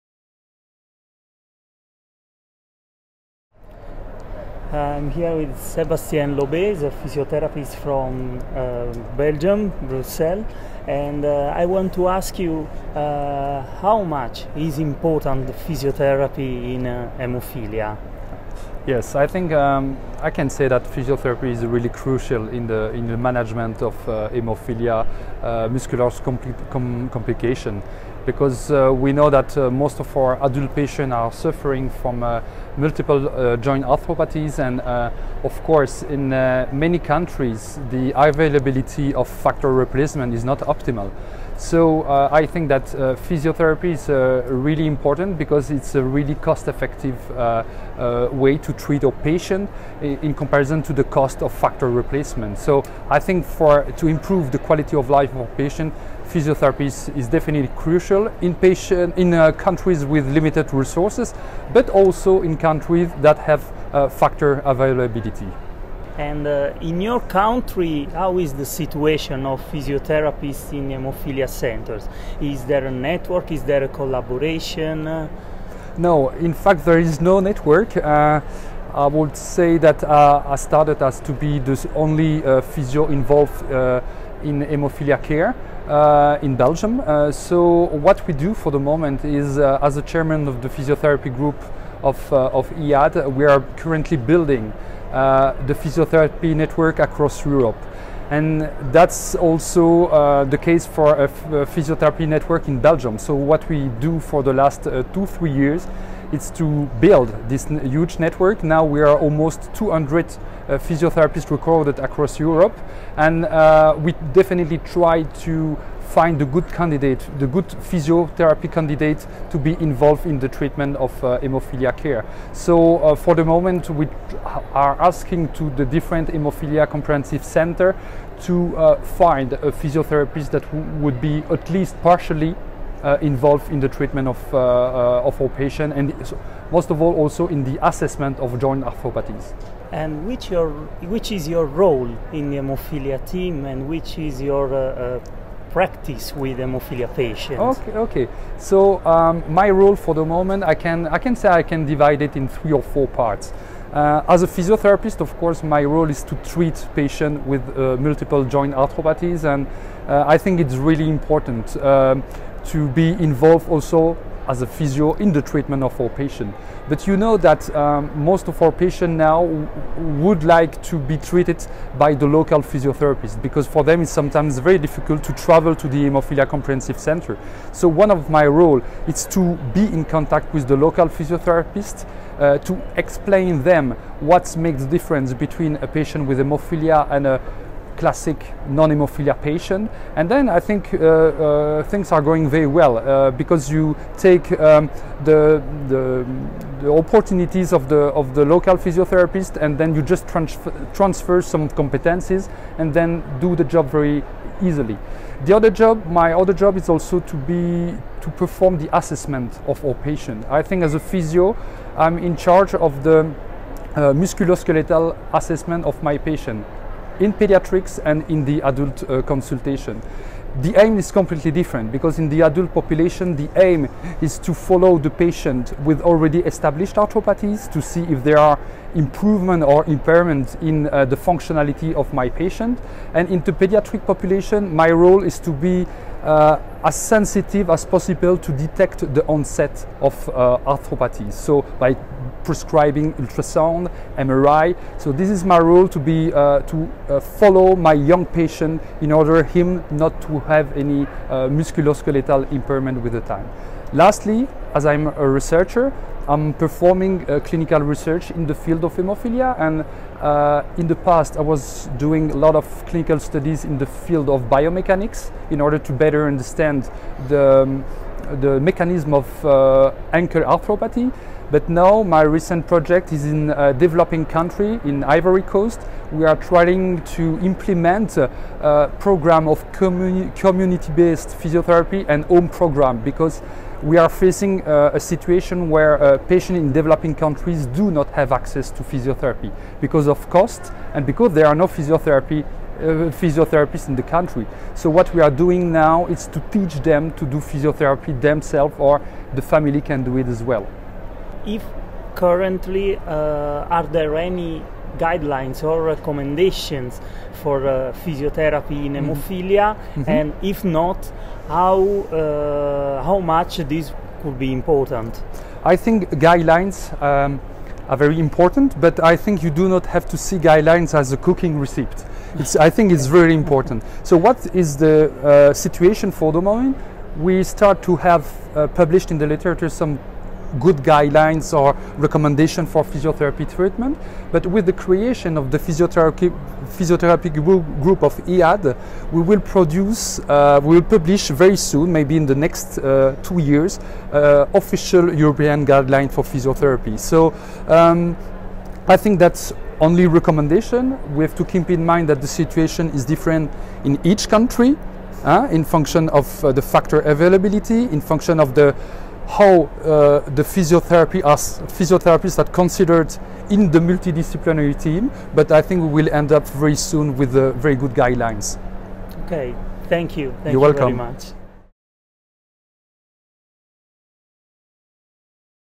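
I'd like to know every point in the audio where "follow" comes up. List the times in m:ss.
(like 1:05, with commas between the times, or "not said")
3:44, 4:07.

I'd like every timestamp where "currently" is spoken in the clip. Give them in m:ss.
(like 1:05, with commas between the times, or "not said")
1:33, 5:02.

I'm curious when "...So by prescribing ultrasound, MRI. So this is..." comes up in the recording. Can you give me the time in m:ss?
4:01.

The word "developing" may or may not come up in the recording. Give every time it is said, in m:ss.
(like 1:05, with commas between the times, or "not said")
4:33, 4:46.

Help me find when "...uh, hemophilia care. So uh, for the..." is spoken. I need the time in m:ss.
2:01.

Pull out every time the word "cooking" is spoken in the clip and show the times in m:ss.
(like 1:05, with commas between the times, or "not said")
5:21.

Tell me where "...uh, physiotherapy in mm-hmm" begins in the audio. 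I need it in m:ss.
5:07.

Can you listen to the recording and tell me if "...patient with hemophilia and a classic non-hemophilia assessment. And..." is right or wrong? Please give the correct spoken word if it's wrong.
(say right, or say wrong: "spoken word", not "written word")
wrong: "patient", not "assessment".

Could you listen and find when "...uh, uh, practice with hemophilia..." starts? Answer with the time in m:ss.
2:24.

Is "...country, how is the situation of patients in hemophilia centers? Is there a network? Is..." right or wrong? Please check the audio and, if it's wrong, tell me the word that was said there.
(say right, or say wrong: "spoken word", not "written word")
wrong: "physiotherapists", not "patients".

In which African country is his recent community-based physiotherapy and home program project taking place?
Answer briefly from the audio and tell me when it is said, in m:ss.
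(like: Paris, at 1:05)
Ivory Coast, at 4:35.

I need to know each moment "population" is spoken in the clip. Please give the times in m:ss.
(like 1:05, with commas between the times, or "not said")
3:42, 3:54.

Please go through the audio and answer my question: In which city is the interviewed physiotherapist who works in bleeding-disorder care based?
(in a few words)
Brussels.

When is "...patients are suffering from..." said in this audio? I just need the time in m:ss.
0:30.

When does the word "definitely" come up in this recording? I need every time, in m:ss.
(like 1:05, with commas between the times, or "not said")
0:57, 1:54.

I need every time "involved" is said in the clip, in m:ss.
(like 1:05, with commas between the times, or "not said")
1:23, 1:59, 2:13, 2:43.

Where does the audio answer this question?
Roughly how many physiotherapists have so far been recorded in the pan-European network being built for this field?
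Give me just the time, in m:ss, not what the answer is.
1:49.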